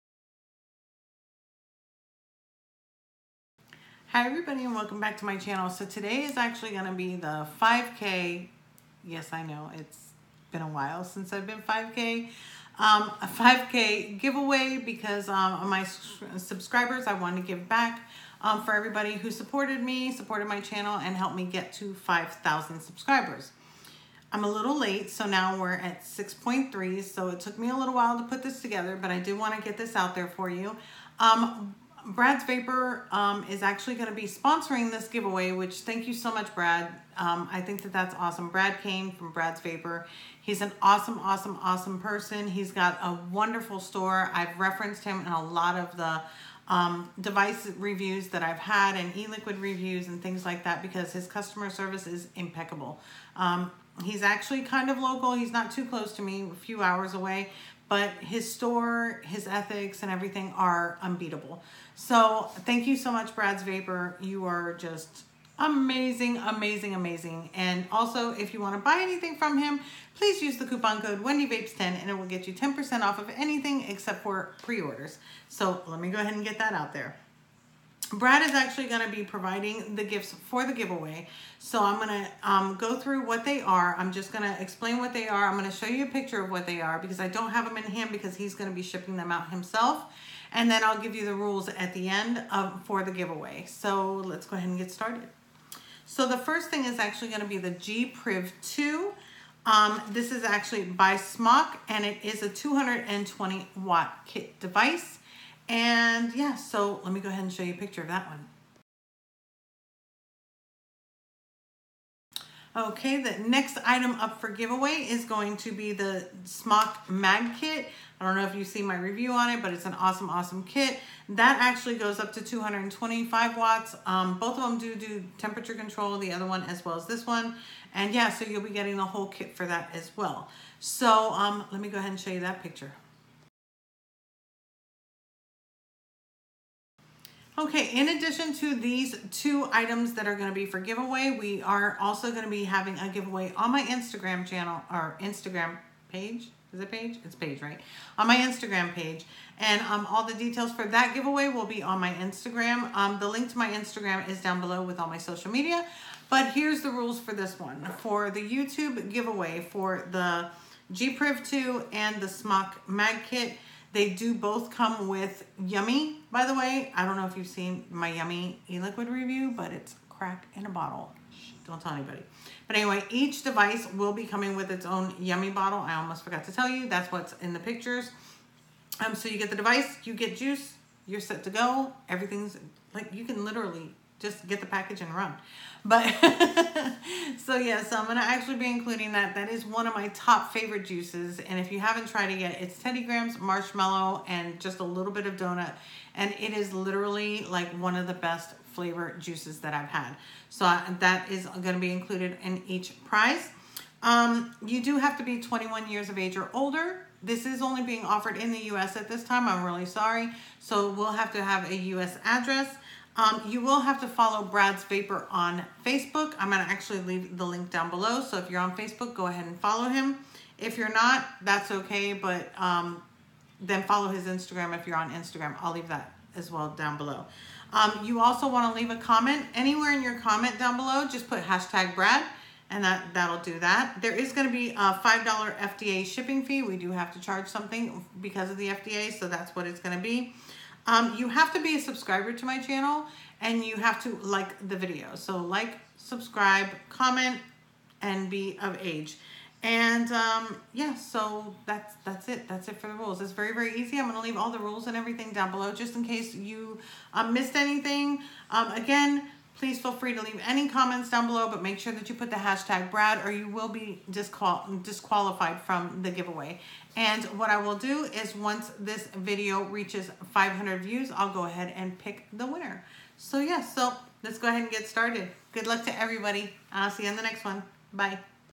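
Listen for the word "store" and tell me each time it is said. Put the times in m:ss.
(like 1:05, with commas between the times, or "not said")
0:43, 0:58.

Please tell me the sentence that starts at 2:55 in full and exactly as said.
I almost forgot to tell you.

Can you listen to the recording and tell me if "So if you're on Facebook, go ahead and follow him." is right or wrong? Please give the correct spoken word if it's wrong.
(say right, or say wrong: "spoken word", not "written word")
right.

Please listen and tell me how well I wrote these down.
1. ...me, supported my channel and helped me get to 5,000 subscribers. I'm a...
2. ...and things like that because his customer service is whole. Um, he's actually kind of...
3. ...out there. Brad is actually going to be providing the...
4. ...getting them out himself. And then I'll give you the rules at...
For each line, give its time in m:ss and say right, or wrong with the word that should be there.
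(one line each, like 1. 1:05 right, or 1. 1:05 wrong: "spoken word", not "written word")
1. 0:19 right
2. 0:50 wrong: "impeccable", not "whole"
3. 1:16 right
4. 1:28 wrong: "shipping", not "getting".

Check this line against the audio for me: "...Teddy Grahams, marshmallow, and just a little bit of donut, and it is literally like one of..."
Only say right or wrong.
right.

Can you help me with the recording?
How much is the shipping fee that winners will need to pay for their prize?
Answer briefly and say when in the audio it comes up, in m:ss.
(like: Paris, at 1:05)
$5, at 3:55.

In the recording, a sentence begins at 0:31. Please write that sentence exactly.
Um, Brad's Vapor um, is actually going to be sponsoring this giveaway, which thank you so much, Brad.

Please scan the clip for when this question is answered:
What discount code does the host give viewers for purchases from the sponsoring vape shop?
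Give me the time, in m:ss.
1:11.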